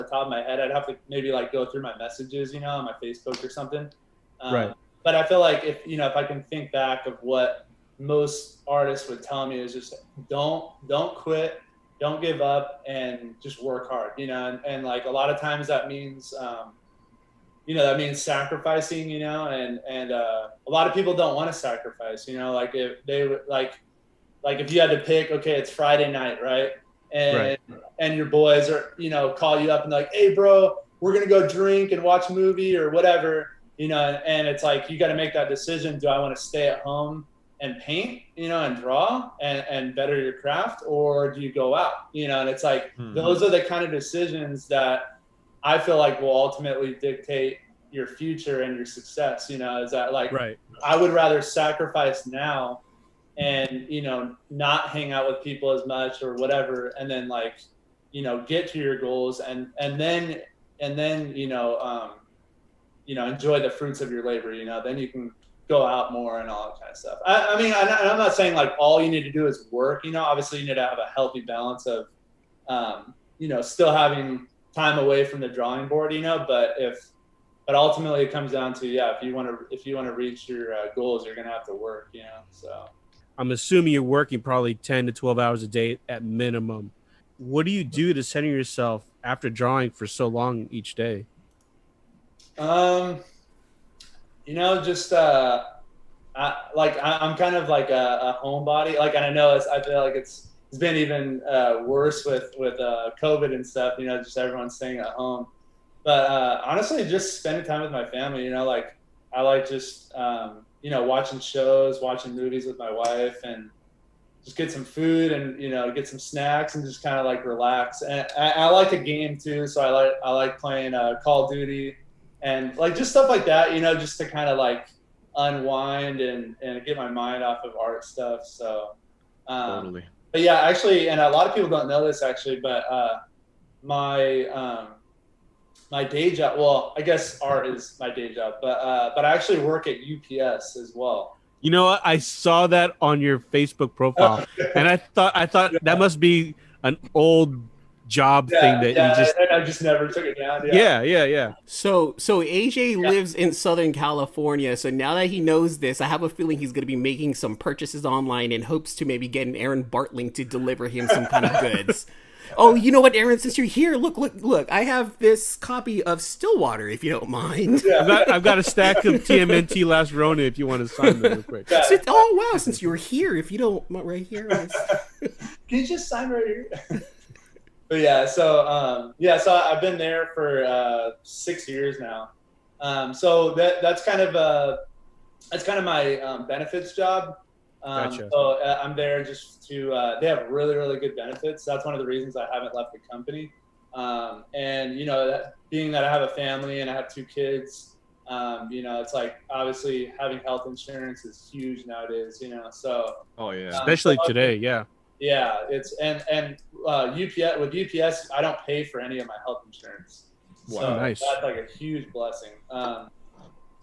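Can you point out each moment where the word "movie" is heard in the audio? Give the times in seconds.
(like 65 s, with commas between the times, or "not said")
32 s, 112 s.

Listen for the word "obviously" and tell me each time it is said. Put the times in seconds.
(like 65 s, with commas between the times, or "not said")
70 s, 199 s.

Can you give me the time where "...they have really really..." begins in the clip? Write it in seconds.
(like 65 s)
190 s.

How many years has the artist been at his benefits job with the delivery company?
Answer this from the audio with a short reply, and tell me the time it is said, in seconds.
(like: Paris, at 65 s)
6, at 181 s.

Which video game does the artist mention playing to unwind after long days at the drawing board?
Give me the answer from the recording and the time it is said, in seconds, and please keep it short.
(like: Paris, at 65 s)
Call of Duty, at 121 s.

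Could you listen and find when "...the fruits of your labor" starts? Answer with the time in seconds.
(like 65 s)
63 s.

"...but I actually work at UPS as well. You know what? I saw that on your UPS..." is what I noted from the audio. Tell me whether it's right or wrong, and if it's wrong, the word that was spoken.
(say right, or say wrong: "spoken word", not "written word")
wrong: "Facebook", not "UPS".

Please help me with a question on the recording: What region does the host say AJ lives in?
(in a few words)
Southern California.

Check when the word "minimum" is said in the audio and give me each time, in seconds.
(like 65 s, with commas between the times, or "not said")
86 s.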